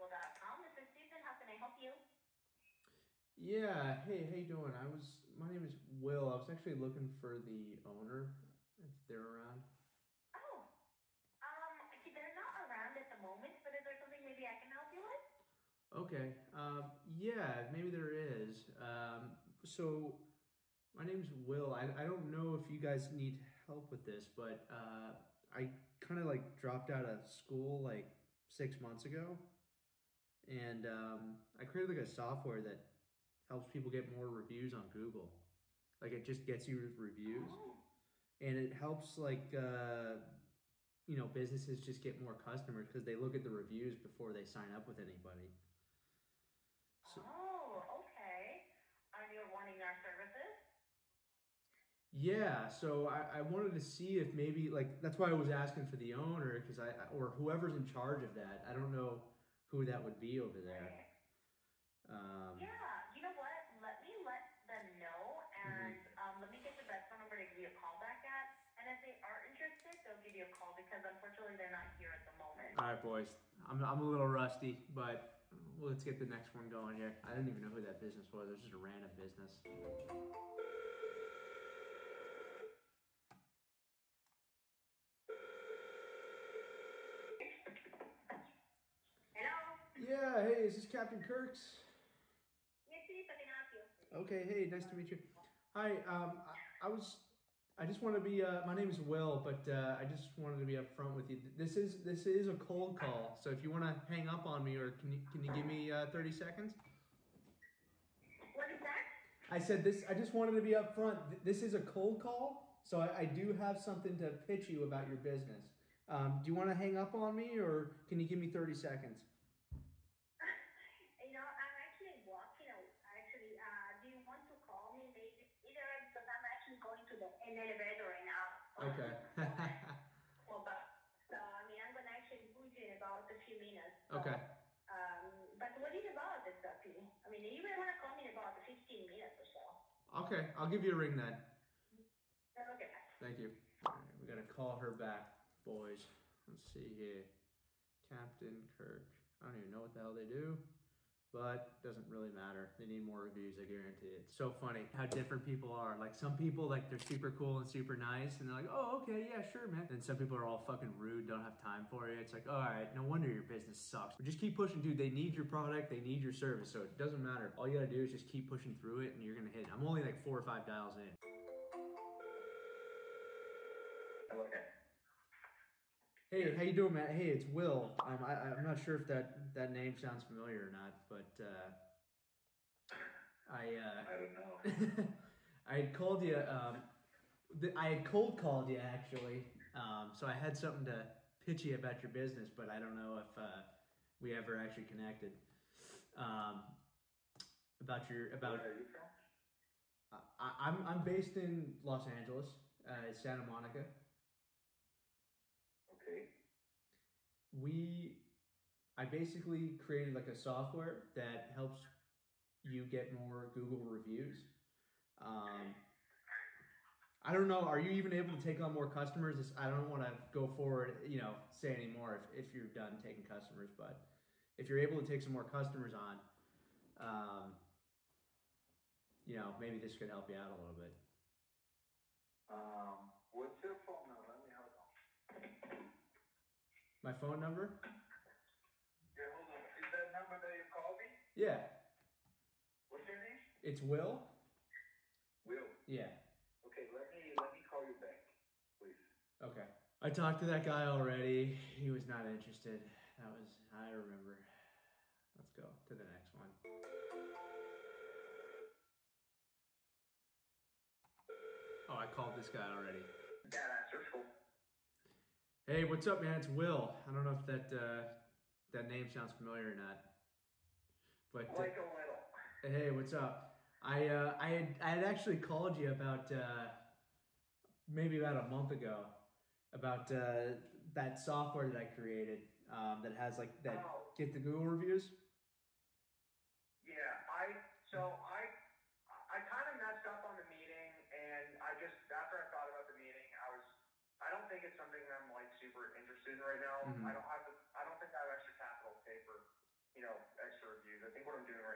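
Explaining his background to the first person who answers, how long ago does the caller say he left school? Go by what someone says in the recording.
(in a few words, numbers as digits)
6 months ago.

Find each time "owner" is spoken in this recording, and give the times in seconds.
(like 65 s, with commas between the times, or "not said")
7 s, 56 s.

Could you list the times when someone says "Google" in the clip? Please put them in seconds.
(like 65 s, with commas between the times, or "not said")
34 s, 213 s, 284 s.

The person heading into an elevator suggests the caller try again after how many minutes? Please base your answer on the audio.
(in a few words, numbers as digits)
15 minutes.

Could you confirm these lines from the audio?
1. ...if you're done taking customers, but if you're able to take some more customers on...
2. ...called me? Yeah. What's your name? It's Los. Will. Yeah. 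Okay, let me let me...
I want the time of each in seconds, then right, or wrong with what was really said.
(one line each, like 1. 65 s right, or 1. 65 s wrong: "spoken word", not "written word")
1. 222 s right
2. 240 s wrong: "Will", not "Los".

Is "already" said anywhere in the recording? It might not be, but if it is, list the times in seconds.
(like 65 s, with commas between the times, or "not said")
250 s, 262 s.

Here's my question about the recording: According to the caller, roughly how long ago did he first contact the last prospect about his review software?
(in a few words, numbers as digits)
about a month ago.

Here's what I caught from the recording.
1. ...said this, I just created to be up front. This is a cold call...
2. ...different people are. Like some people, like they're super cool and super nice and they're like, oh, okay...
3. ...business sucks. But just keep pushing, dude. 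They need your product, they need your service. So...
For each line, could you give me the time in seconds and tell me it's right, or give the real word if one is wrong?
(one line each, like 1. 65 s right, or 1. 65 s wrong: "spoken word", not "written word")
1. 109 s wrong: "wanted", not "created"
2. 155 s right
3. 163 s right.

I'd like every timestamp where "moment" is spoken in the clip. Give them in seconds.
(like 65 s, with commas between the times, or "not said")
13 s, 72 s.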